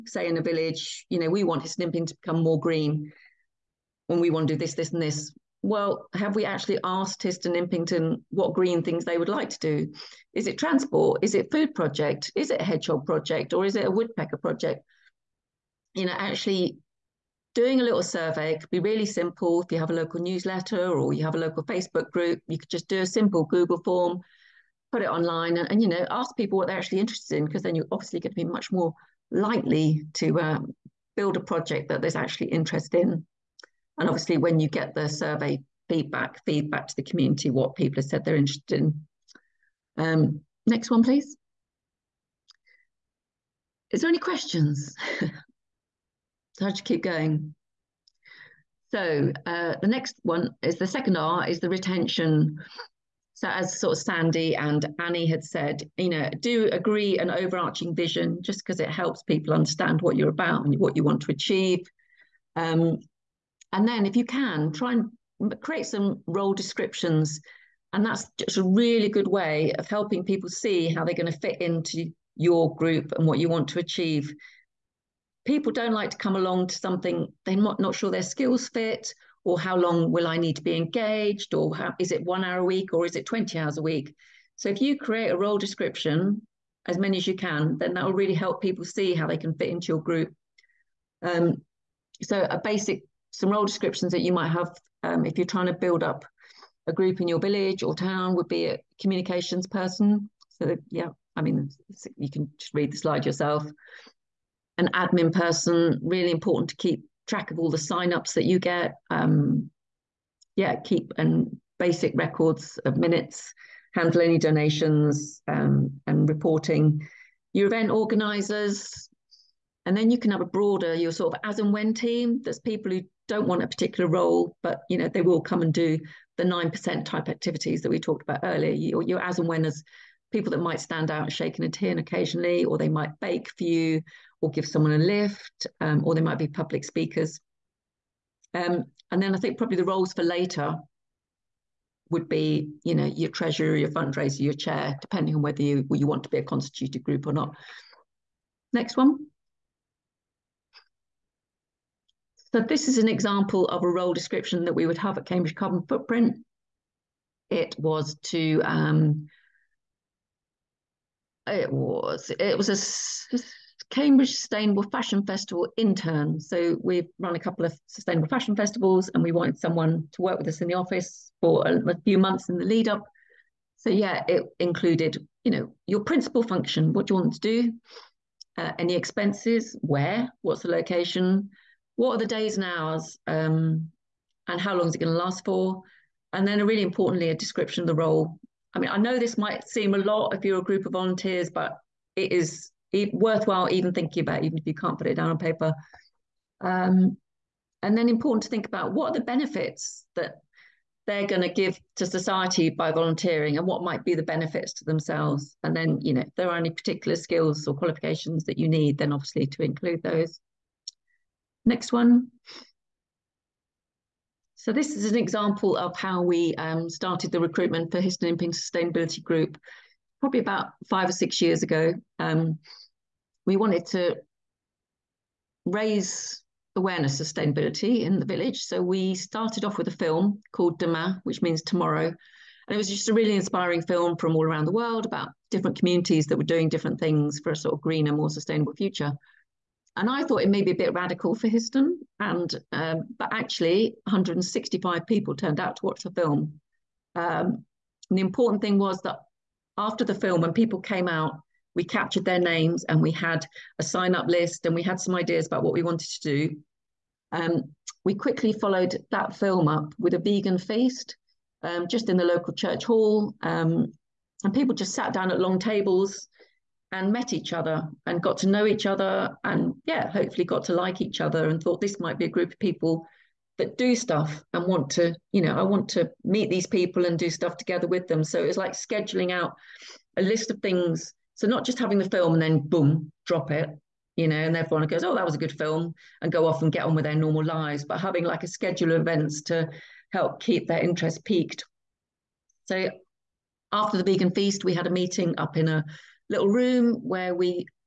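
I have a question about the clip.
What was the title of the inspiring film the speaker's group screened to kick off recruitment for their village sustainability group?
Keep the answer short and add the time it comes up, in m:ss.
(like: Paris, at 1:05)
Demain, at 3:50.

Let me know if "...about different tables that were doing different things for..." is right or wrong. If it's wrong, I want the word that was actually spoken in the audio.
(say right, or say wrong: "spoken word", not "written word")
wrong: "communities", not "tables".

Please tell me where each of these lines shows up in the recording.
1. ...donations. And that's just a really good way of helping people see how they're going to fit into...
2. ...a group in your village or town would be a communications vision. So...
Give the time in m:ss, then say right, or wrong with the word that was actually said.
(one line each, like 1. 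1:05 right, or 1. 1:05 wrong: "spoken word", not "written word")
1. 1:06 wrong: "descriptions", not "donations"
2. 1:36 wrong: "person", not "vision".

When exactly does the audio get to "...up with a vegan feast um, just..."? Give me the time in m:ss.
4:19.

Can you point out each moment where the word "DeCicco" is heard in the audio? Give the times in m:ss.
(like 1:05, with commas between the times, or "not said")
not said.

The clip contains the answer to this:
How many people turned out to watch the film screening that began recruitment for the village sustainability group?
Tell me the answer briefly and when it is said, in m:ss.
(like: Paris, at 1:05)
165, at 4:04.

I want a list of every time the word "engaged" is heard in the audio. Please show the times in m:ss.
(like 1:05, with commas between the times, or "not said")
1:20.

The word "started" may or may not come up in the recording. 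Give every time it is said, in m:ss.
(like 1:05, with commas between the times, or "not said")
3:36, 3:49.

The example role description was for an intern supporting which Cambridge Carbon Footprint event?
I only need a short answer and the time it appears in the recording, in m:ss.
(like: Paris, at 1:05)
Cambridge Sustainable Fashion Festival, at 2:43.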